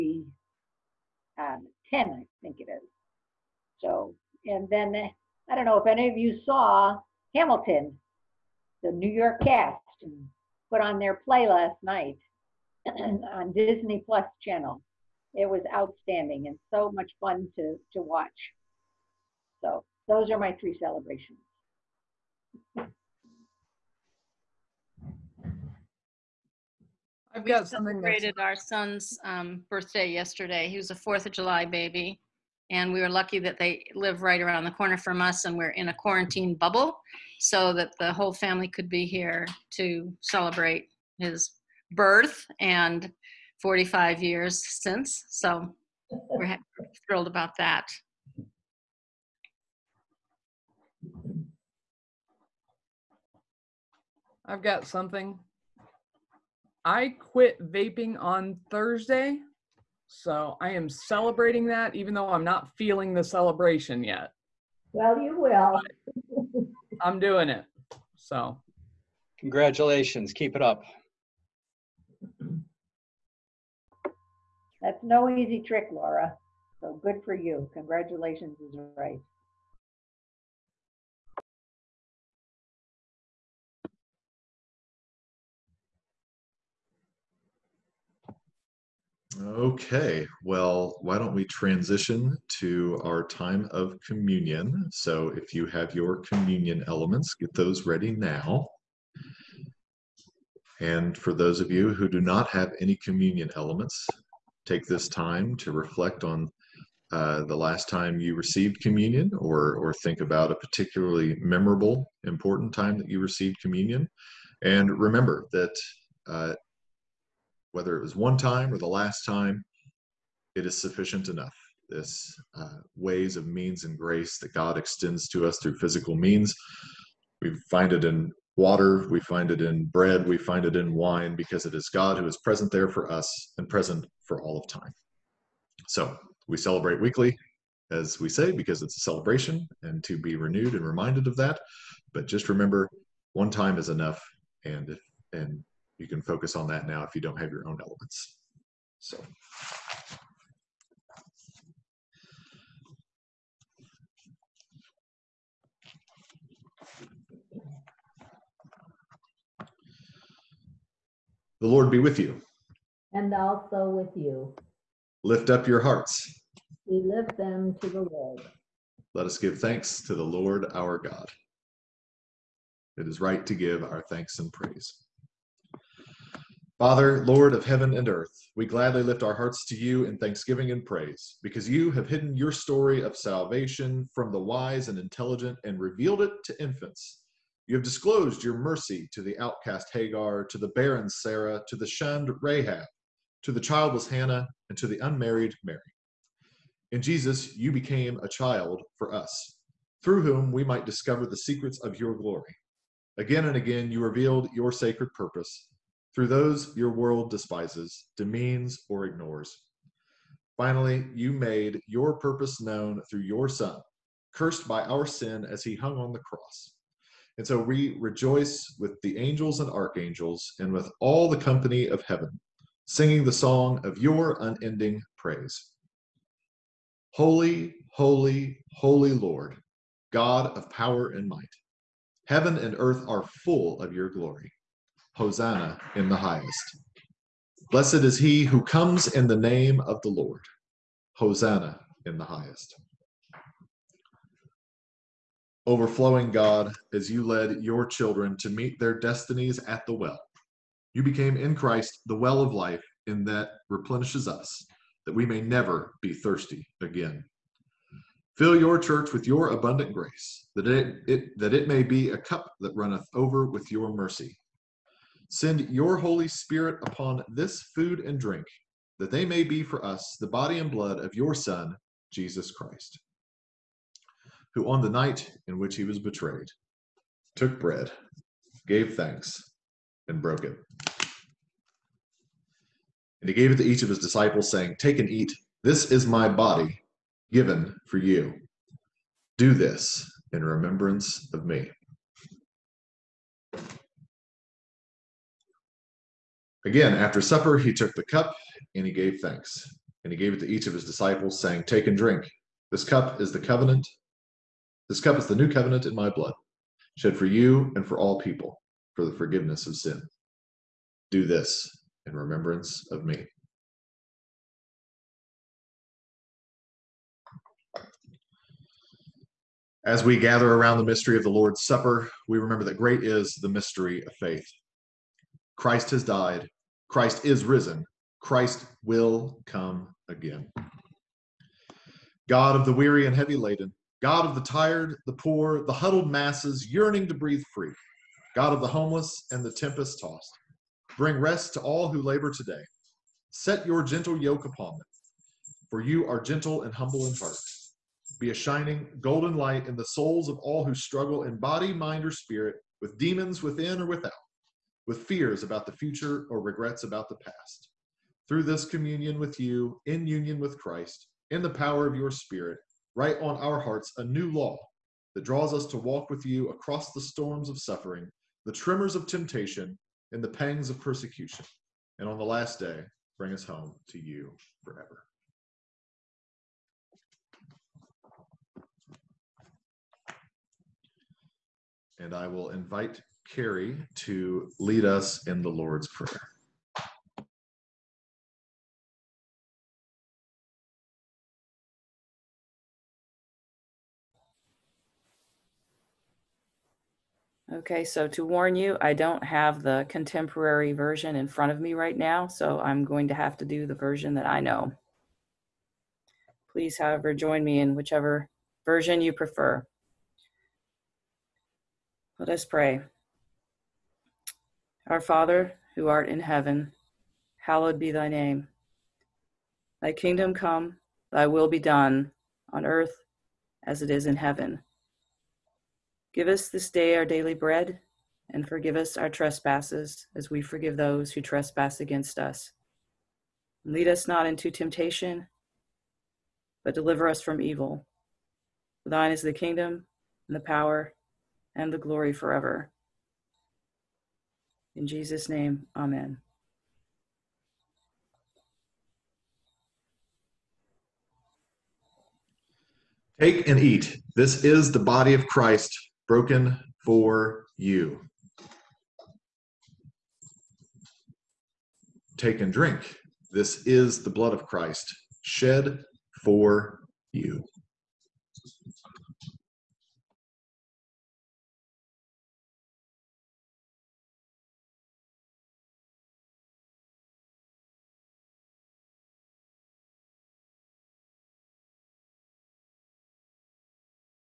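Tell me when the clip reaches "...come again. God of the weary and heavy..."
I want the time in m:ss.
5:29.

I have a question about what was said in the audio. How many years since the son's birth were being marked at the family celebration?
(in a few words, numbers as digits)
45.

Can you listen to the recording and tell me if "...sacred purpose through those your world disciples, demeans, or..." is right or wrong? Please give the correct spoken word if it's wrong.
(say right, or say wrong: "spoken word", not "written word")
wrong: "despises", not "disciples".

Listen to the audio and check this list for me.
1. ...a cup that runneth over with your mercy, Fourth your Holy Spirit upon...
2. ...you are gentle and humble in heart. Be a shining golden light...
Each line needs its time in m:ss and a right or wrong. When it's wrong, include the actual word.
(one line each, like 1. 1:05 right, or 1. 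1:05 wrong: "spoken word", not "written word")
1. 4:22 wrong: "Send", not "Fourth"
2. 5:45 right.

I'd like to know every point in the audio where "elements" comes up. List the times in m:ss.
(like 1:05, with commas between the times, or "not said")
1:36, 1:43, 2:27.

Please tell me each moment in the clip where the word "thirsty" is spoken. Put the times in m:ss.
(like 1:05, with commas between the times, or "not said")
4:16.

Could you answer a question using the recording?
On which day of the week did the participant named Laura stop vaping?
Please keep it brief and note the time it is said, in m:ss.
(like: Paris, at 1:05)
Thursday, at 0:58.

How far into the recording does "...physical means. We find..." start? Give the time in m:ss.
2:05.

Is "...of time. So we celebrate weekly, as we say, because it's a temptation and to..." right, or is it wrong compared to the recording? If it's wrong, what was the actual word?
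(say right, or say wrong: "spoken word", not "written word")
wrong: "celebration", not "temptation".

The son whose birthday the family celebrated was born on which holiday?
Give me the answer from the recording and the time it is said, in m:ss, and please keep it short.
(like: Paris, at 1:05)
Fourth of July, at 0:30.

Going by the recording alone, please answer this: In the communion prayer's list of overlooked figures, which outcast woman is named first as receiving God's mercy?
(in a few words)
Hagar.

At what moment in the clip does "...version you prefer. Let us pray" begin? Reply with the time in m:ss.
6:48.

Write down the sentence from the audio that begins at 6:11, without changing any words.
And on the last day, bring us home to you forever.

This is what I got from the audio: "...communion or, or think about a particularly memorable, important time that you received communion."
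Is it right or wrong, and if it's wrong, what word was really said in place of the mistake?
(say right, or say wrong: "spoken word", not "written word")
right.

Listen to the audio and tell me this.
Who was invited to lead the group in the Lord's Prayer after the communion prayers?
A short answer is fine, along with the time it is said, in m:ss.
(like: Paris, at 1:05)
Carrie, at 6:23.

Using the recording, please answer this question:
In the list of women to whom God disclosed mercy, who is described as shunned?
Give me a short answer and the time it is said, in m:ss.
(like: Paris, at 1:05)
Rahab, at 3:12.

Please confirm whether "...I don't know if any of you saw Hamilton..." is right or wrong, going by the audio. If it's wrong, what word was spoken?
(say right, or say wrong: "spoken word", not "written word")
right.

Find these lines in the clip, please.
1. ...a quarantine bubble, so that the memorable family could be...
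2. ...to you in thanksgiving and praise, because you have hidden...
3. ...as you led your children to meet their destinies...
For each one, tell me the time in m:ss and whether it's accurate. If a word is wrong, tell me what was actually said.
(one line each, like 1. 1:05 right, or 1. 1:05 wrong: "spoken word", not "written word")
1. 0:35 wrong: "whole", not "memorable"
2. 2:59 right
3. 4:06 right.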